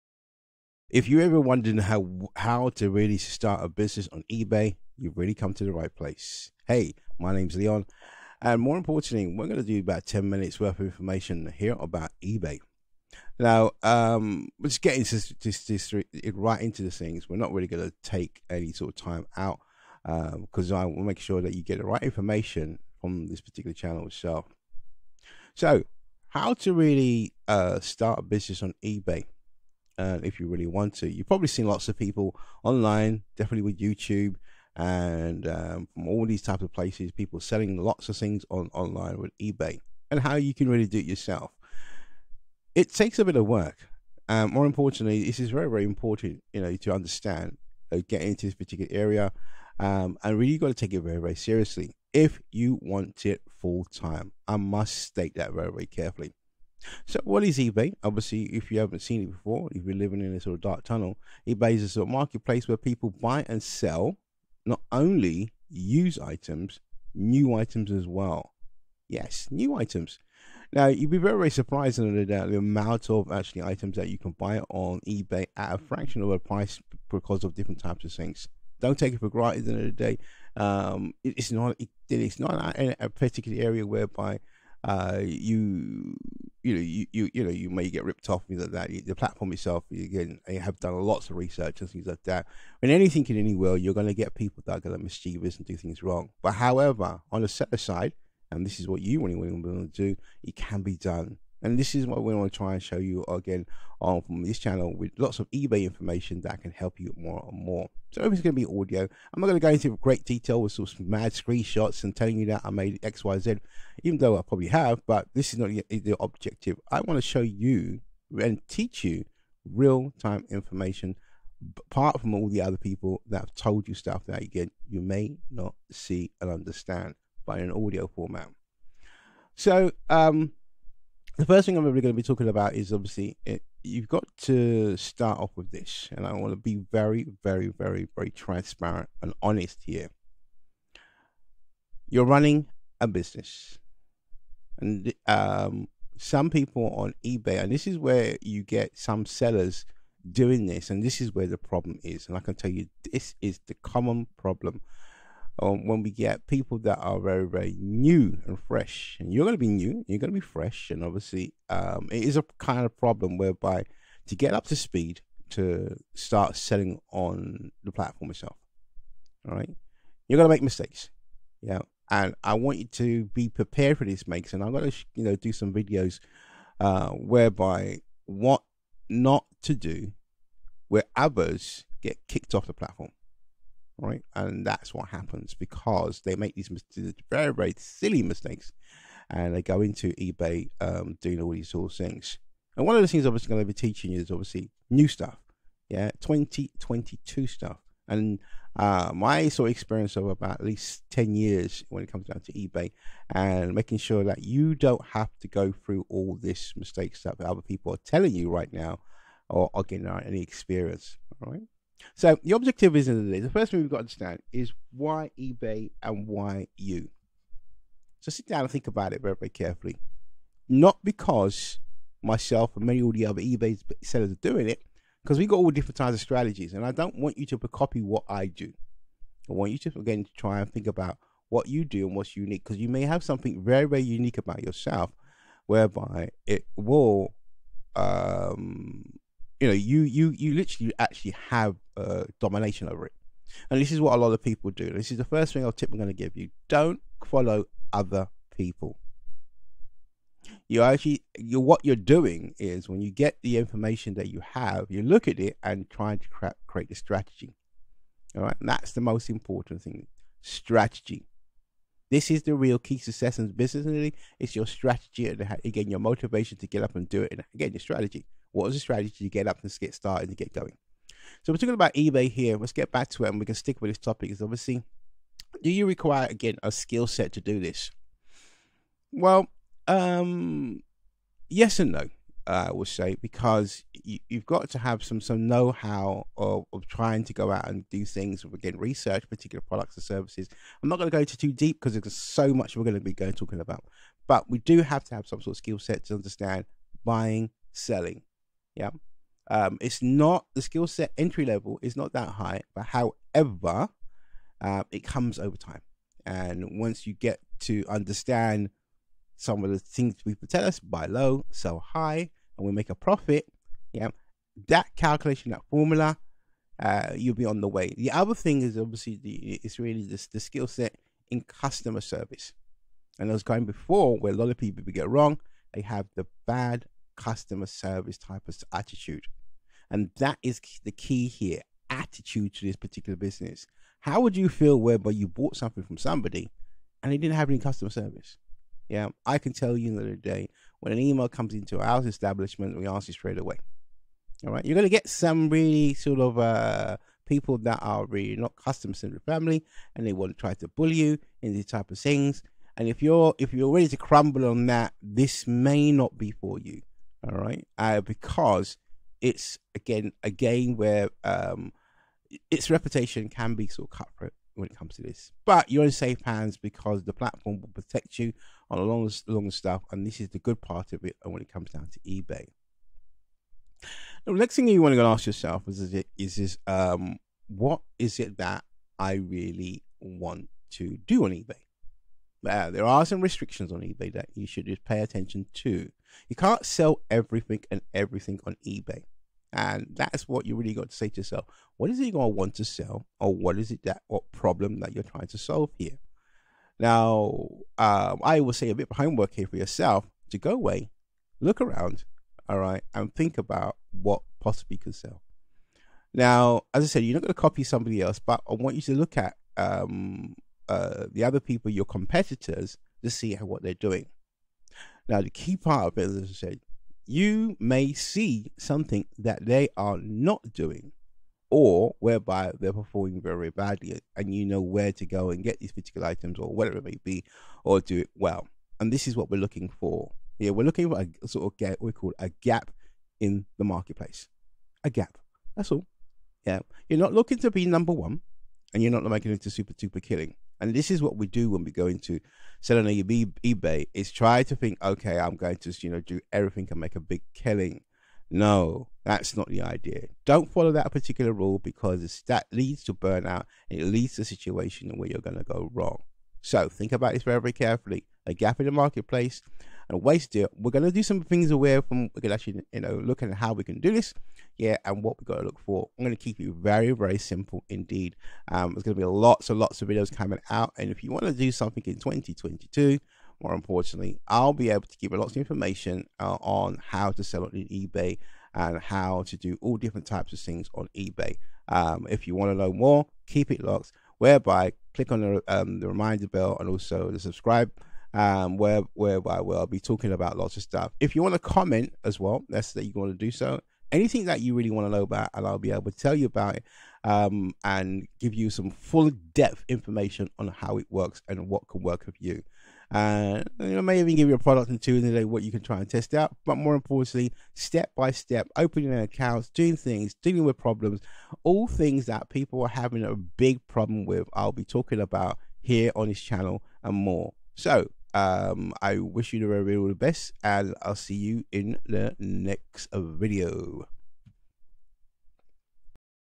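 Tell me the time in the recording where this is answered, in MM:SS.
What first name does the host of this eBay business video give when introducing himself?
00:07.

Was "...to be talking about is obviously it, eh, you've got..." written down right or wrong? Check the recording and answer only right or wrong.
right.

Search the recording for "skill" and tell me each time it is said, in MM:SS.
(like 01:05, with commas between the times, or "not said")
04:36, 04:55, 05:00, 05:20.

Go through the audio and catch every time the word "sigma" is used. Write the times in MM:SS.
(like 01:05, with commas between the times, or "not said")
not said.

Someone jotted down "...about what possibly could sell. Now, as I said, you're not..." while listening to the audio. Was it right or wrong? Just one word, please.
right.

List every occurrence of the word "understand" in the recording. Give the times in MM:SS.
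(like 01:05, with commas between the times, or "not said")
00:46, 02:06, 03:34, 04:56, 05:07.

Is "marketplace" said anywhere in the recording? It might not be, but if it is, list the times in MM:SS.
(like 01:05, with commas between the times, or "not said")
01:02, 07:13, 07:38.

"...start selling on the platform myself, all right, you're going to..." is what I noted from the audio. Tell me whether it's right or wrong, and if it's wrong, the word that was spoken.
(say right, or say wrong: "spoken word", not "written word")
wrong: "itself", not "myself".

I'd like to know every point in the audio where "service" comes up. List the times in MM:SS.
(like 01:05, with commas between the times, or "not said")
04:50, 05:22, 05:27, 05:37.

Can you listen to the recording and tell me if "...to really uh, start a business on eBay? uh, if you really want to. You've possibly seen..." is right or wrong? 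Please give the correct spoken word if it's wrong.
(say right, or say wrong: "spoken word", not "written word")
wrong: "probably", not "possibly".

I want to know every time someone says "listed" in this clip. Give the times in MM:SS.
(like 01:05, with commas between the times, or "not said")
not said.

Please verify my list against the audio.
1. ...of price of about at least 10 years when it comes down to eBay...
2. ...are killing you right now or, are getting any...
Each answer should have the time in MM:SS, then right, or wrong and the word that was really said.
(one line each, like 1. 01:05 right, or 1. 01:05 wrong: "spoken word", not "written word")
1. 03:19 wrong: "experience", not "price"
2. 03:27 wrong: "telling", not "killing".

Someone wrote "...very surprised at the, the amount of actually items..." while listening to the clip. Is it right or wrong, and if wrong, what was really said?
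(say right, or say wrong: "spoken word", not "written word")
right.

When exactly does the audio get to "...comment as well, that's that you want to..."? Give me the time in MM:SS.
08:11.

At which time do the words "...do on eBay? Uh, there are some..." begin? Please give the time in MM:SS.
06:21.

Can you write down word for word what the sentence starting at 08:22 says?
And uh, you know, maybe even give you a product and two in the day what you can try and test out.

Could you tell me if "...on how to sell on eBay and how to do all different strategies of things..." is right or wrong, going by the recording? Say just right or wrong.
wrong.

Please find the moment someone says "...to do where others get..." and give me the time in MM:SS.
02:59.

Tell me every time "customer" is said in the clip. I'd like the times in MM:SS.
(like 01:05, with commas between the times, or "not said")
05:21, 05:27, 05:37, 05:48.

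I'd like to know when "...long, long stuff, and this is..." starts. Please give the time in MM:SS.
06:08.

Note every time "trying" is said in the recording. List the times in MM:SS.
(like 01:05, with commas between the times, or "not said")
04:15, 04:46, 06:35.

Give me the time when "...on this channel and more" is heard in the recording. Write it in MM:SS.
08:35.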